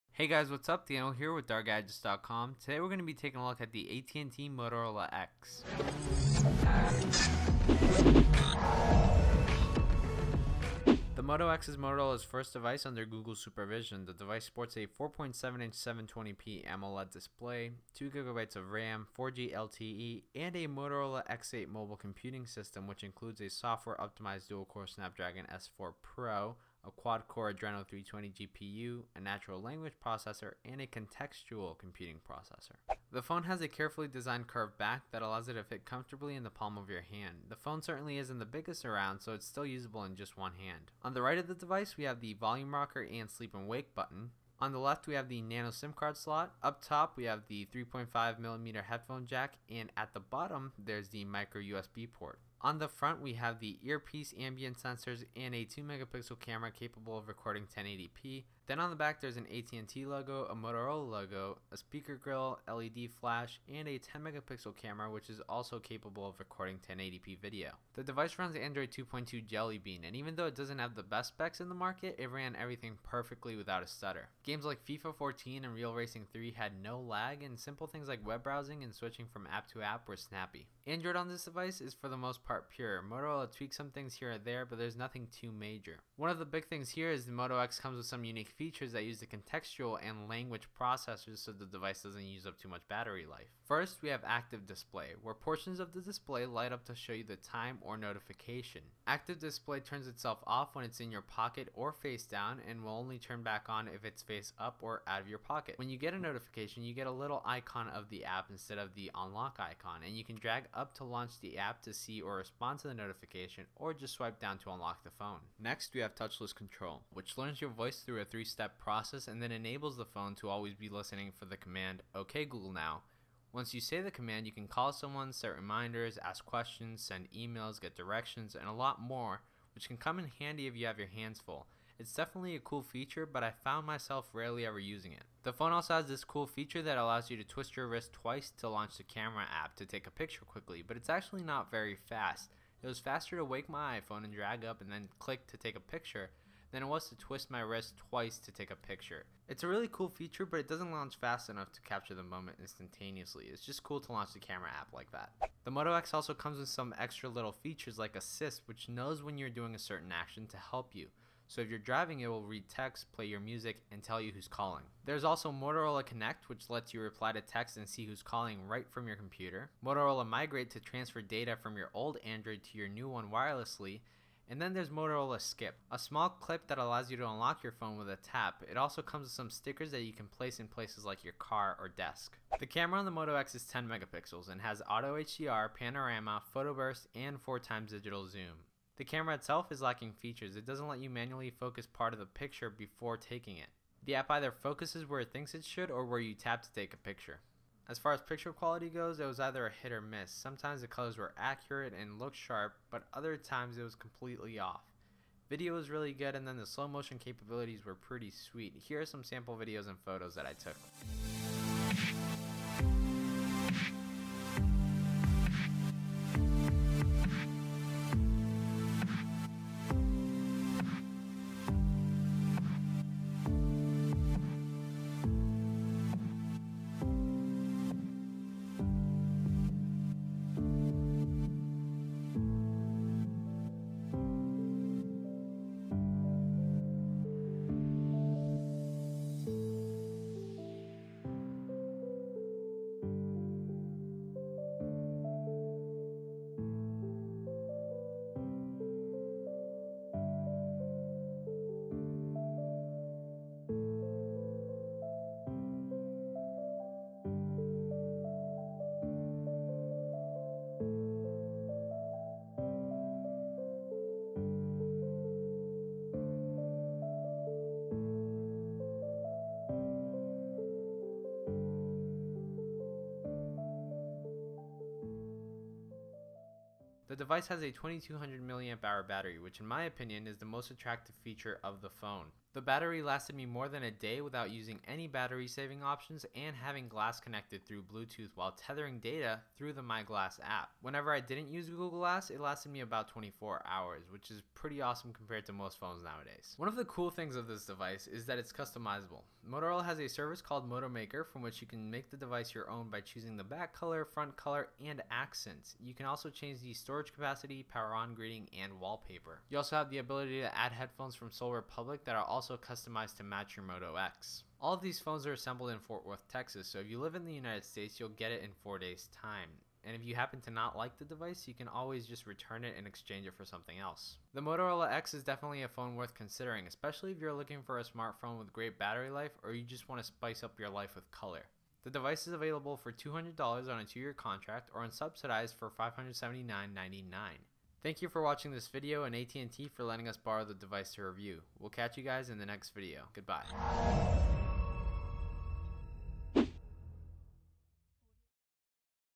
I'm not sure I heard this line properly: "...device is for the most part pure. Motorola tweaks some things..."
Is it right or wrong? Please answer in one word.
right.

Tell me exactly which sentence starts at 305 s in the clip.
You can also change the storage capacity, power on greeting, and wallpaper.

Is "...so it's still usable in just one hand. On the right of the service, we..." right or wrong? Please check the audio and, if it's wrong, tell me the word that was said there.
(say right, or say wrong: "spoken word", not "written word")
wrong: "device", not "service".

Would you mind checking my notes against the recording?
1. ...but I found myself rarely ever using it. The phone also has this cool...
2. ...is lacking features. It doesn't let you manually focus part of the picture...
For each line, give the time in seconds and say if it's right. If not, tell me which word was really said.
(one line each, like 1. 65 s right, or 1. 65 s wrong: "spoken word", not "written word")
1. 133 s right
2. 189 s right.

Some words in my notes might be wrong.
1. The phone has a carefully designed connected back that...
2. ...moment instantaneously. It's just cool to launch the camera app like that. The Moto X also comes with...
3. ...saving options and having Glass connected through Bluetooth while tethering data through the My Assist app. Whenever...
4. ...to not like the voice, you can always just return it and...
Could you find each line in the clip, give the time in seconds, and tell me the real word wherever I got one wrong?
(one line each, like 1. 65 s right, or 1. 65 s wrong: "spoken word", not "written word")
1. 33 s wrong: "curved", not "connected"
2. 152 s right
3. 285 s wrong: "Glass", not "Assist"
4. 320 s wrong: "device", not "voice".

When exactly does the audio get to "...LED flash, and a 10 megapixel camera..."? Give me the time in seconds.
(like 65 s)
62 s.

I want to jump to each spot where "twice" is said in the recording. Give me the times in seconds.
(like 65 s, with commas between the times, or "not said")
138 s, 148 s.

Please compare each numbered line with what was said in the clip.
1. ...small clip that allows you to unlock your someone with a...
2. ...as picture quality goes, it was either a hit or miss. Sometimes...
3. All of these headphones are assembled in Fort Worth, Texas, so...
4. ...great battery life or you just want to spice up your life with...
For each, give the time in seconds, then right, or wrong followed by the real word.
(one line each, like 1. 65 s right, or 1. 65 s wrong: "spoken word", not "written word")
1. 175 s wrong: "phone", not "someone"
2. 198 s right
3. 314 s wrong: "phones", not "headphones"
4. 328 s right.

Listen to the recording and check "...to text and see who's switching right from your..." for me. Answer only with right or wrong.
wrong.